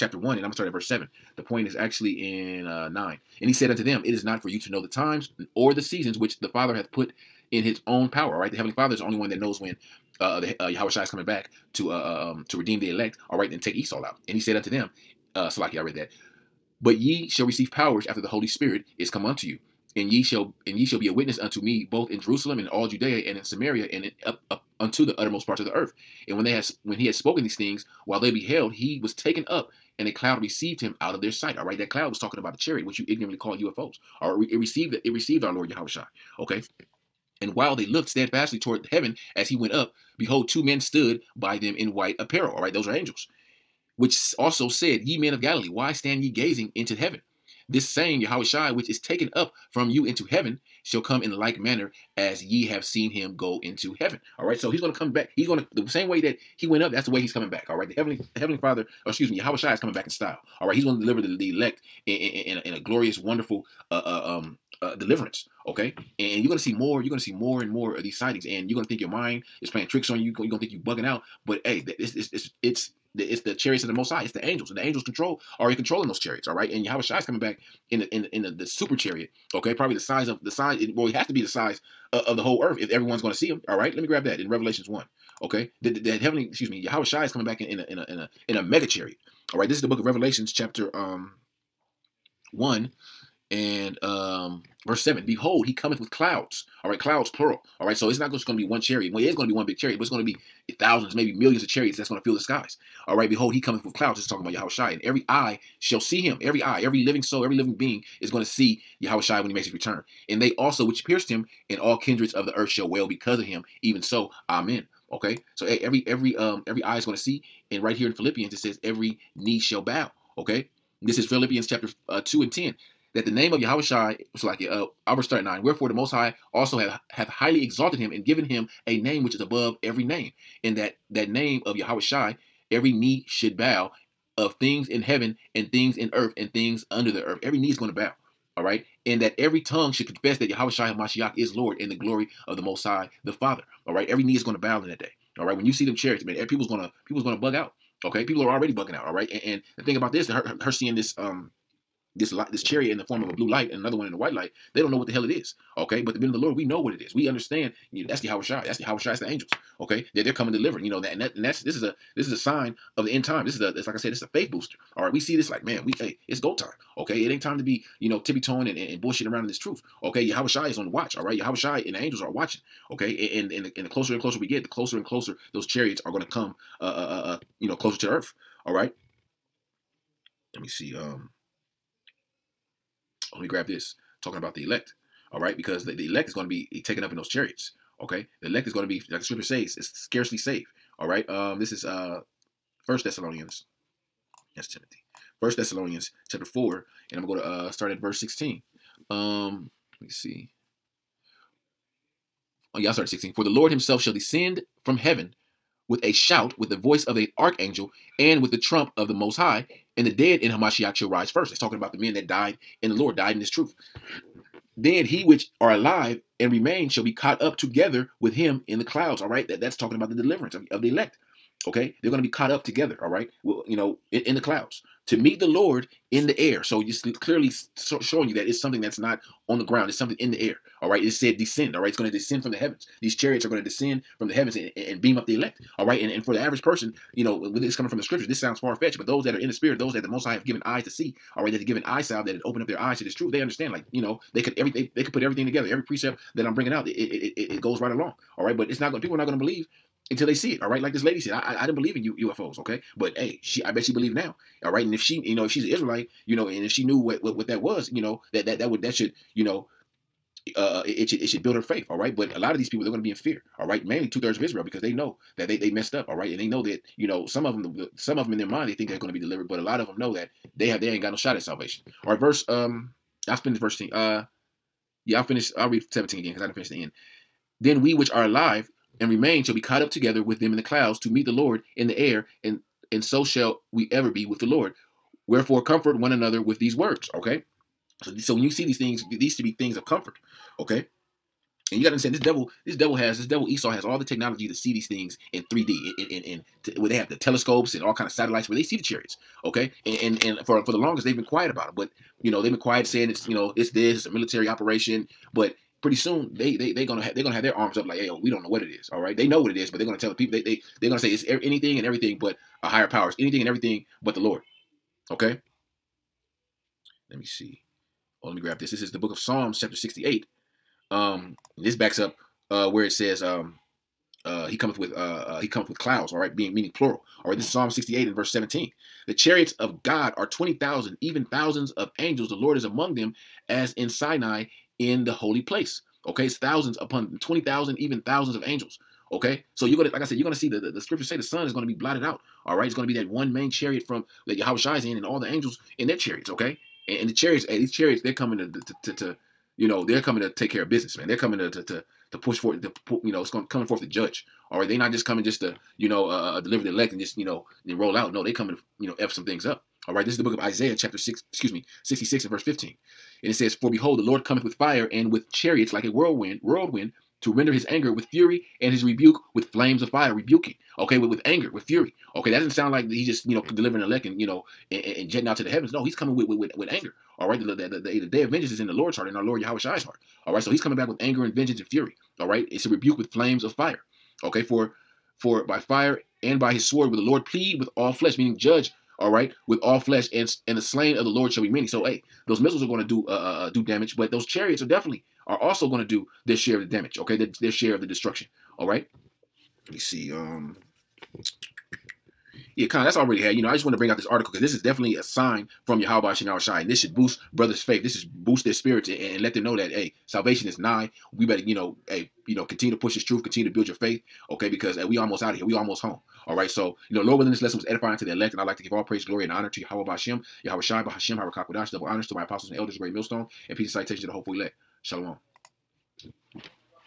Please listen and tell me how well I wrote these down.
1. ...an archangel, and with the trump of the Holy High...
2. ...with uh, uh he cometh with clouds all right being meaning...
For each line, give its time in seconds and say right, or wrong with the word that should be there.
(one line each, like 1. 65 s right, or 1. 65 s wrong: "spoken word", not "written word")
1. 207 s wrong: "Most", not "Holy"
2. 324 s right.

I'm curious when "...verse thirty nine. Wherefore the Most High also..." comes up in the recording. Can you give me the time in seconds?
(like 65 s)
125 s.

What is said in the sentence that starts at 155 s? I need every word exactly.
Okay, but the men of the Lord, we know what it is.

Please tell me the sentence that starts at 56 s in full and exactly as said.
That's the way he's coming back.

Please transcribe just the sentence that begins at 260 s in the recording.
Uh, uh it, it should it should build her faith, all right.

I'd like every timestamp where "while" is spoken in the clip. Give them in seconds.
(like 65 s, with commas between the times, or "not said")
28 s, 37 s.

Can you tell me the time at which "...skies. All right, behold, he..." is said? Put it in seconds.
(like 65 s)
102 s.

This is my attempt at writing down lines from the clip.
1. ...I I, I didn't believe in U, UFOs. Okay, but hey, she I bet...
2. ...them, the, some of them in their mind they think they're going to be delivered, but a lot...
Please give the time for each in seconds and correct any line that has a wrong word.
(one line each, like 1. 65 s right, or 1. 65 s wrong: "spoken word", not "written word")
1. 251 s right
2. 267 s right.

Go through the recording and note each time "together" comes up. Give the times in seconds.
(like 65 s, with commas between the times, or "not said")
217 s, 222 s, 245 s, 279 s.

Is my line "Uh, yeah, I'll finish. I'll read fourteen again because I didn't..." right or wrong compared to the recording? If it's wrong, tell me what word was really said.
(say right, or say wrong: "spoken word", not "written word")
wrong: "seventeen", not "fourteen".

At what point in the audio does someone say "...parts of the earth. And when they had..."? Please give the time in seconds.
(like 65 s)
25 s.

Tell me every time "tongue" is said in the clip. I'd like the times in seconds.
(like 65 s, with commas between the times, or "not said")
139 s.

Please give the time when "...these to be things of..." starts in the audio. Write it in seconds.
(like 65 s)
289 s.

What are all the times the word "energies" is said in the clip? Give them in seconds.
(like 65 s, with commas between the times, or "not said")
not said.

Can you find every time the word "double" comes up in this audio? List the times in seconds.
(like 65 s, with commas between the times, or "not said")
421 s.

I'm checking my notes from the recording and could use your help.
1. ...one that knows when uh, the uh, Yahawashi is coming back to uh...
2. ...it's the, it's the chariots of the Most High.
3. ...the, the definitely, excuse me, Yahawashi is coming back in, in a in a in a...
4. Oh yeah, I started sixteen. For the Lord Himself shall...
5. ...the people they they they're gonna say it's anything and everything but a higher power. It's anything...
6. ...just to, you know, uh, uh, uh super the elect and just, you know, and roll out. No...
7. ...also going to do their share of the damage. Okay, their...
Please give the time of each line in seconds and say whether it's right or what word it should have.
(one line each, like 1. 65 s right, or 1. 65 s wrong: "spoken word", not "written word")
1. 9 s right
2. 72 s right
3. 85 s wrong: "heavenly", not "definitely"
4. 202 s right
5. 310 s right
6. 355 s wrong: "deliver", not "super"
7. 395 s right.